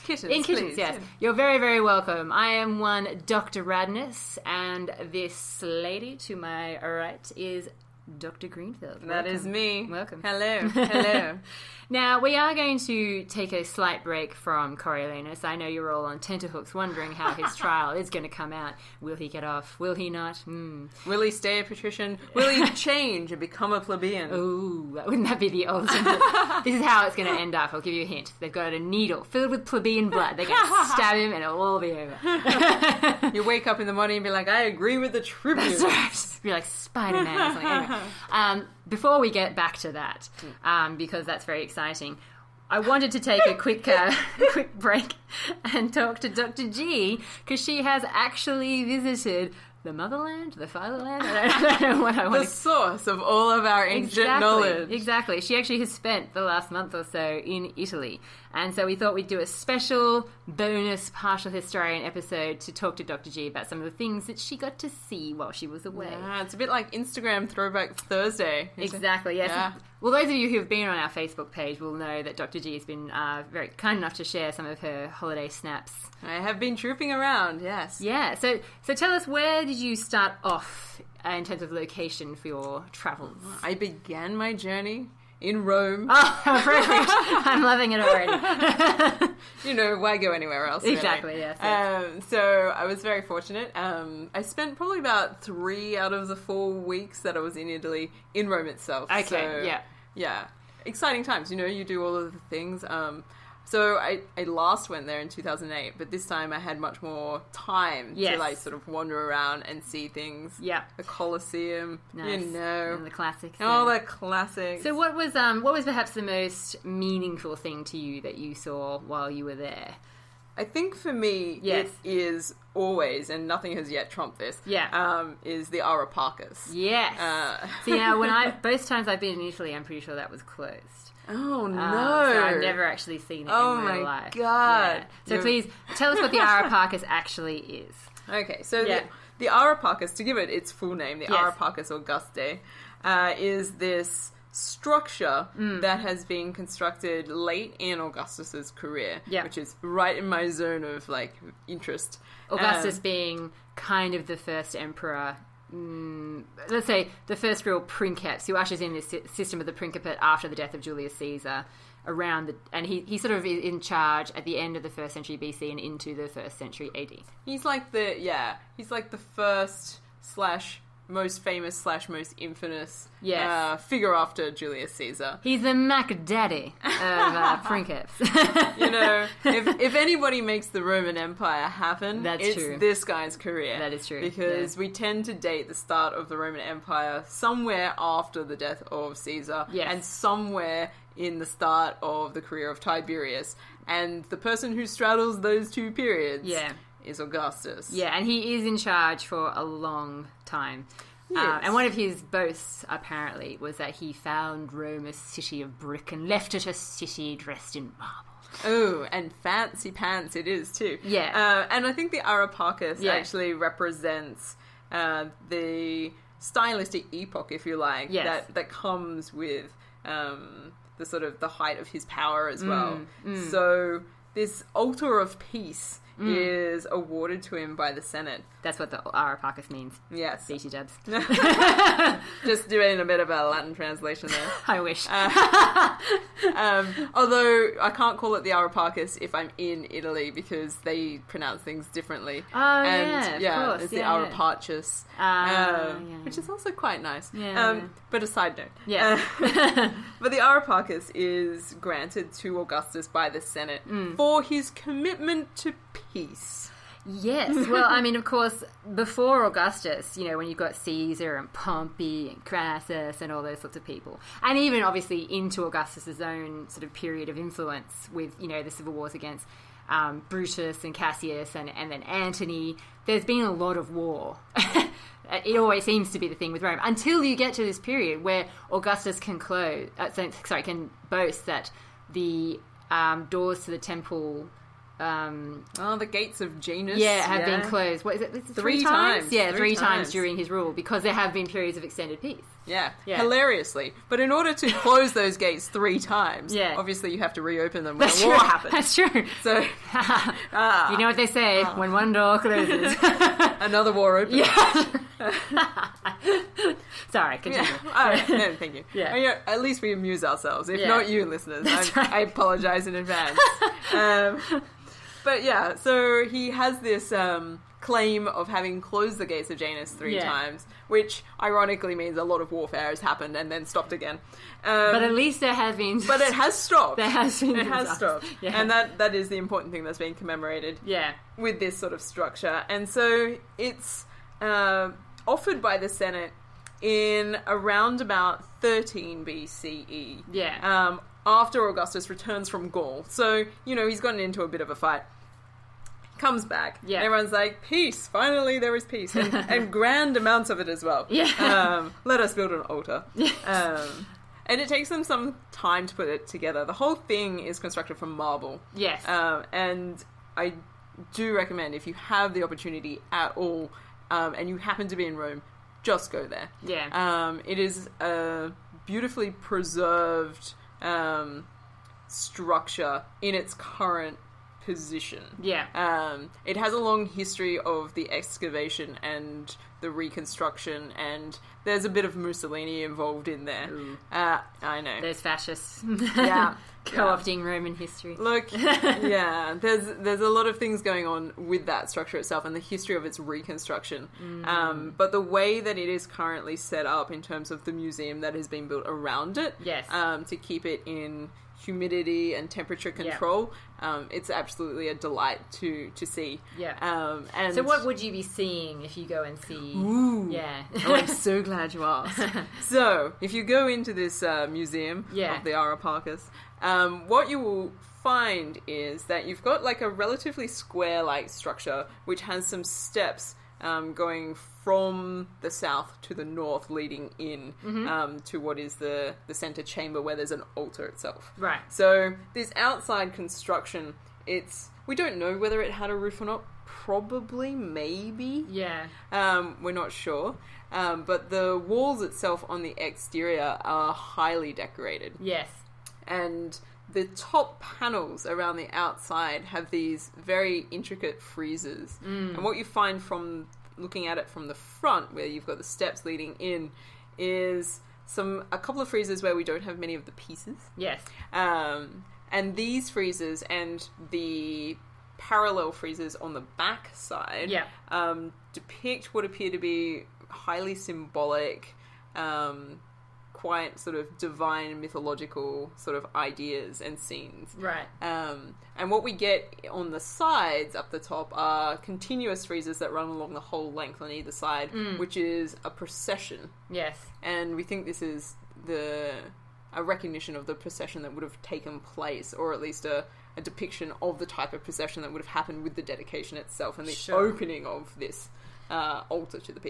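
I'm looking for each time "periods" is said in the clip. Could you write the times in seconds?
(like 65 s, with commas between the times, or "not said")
195 s, 266 s, 277 s, 291 s.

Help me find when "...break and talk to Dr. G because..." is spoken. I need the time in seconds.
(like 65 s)
44 s.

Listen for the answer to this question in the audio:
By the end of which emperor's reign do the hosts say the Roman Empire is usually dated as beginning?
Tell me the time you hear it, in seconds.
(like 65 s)
192 s.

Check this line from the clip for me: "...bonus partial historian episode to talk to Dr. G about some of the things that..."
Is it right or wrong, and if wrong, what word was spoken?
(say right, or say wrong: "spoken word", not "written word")
right.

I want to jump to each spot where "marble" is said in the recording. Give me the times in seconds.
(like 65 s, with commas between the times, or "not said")
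207 s, 358 s.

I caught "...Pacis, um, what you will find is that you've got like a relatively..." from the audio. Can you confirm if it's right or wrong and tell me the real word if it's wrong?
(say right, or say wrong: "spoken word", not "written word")
right.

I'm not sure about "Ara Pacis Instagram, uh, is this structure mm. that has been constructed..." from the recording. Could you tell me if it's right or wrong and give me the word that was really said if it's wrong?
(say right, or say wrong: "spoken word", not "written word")
wrong: "Augustae", not "Instagram".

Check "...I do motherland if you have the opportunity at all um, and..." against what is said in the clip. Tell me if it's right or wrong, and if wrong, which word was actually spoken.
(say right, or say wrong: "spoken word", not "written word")
wrong: "recommend", not "motherland".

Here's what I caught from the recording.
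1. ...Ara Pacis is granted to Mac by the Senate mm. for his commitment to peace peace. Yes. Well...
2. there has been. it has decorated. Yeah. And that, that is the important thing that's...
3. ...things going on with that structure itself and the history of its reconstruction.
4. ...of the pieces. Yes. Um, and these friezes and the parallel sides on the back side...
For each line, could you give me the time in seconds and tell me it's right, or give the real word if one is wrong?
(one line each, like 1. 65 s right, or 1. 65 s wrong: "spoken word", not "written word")
1. 250 s wrong: "Augustus", not "Mac"
2. 326 s wrong: "stopped", not "decorated"
3. 390 s right
4. 459 s wrong: "friezes", not "sides".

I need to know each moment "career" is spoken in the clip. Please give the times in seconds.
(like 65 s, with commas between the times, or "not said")
148 s, 183 s, 192 s.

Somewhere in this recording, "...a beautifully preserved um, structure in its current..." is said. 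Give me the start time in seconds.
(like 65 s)
367 s.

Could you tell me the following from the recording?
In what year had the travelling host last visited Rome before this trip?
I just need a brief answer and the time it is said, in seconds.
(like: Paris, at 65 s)
2008, at 105 s.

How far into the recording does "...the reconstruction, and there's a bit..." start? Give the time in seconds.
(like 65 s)
379 s.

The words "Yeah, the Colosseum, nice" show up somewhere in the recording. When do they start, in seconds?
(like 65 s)
110 s.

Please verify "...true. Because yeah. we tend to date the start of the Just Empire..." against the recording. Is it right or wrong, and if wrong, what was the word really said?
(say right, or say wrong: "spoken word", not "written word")
wrong: "Roman", not "Just".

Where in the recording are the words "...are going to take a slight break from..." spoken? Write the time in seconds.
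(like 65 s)
12 s.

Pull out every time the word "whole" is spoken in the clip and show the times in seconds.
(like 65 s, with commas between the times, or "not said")
356 s, 483 s.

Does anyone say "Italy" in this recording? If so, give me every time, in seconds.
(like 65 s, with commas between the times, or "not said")
57 s, 97 s, 129 s, 239 s.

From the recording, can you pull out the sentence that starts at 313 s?
Um, but yeah, so he has this um, claim of having closed the gates of Janus three Yeah.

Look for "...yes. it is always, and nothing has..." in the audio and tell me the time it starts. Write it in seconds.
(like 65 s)
121 s.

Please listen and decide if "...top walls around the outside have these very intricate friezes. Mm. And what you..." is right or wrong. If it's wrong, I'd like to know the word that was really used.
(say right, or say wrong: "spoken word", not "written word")
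wrong: "panels", not "walls".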